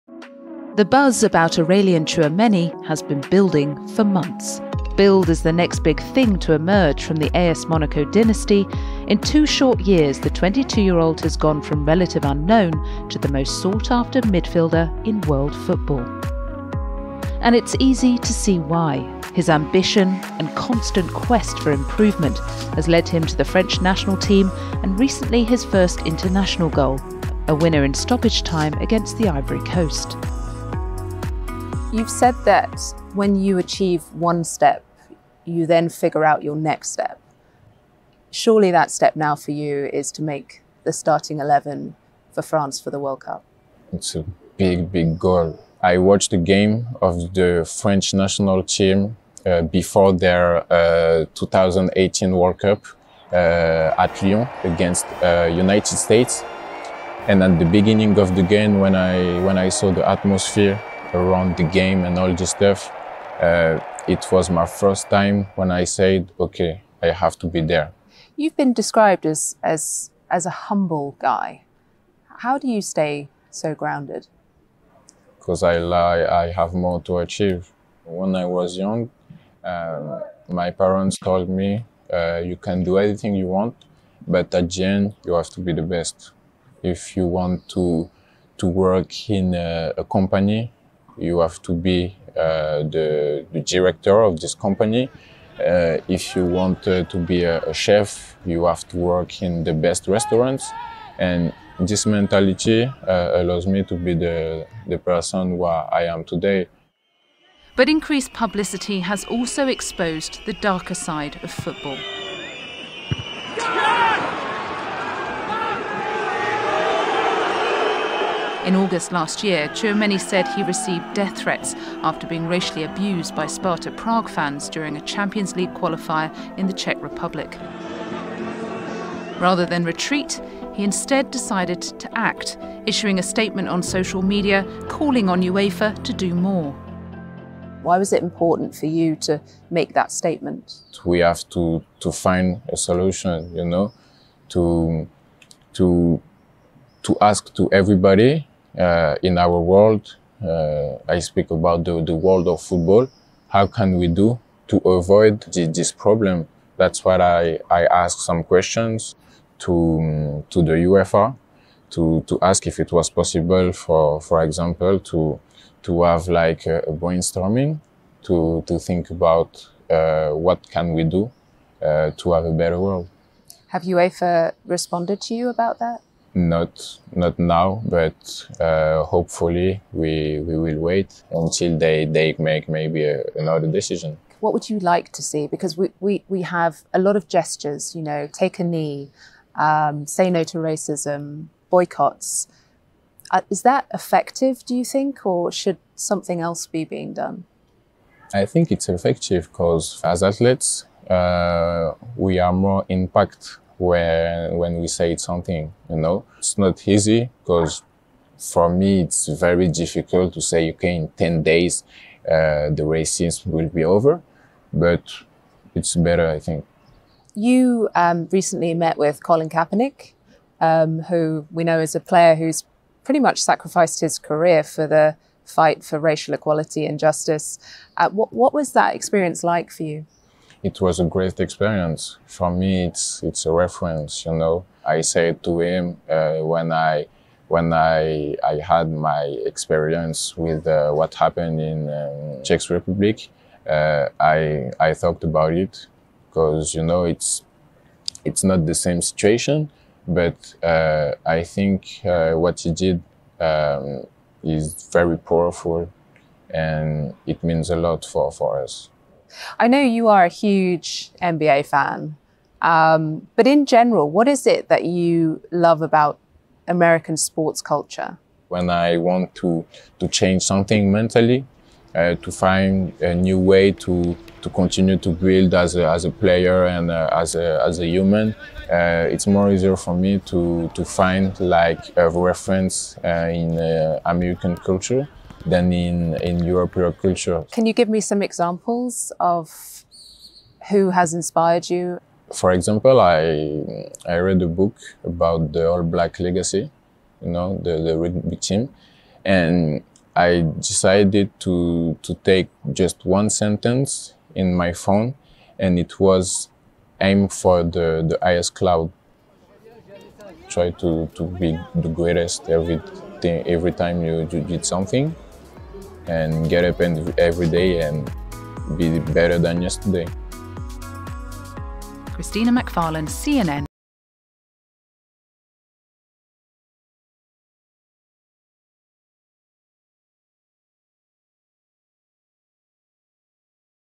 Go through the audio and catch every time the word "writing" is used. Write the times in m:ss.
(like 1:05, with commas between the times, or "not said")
not said.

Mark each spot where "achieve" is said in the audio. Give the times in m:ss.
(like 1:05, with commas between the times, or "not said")
0:33, 1:17.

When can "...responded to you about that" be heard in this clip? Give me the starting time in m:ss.
2:54.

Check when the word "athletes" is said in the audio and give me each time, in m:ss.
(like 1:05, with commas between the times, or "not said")
3:20.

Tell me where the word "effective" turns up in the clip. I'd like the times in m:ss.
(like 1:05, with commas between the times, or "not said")
3:13, 3:18.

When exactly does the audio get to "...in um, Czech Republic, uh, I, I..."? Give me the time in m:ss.
4:01.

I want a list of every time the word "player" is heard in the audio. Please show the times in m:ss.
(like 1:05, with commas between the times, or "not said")
3:42, 4:36.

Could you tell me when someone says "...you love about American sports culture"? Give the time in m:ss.
4:24.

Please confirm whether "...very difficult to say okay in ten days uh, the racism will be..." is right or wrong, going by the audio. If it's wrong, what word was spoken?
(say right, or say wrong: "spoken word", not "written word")
right.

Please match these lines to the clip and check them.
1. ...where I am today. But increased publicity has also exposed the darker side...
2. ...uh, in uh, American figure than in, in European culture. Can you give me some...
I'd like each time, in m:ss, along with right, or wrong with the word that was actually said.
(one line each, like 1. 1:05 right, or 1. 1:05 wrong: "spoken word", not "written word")
1. 1:45 right
2. 4:43 wrong: "culture", not "figure".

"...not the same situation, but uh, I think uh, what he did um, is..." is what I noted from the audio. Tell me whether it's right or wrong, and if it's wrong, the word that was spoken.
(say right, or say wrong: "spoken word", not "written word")
right.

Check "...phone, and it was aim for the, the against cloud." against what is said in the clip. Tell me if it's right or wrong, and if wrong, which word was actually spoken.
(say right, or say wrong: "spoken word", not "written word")
wrong: "highest", not "against".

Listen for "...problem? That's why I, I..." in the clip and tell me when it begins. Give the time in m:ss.
2:35.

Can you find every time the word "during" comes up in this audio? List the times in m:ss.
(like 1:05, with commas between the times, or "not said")
2:04.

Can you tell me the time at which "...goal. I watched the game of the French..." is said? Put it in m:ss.
0:45.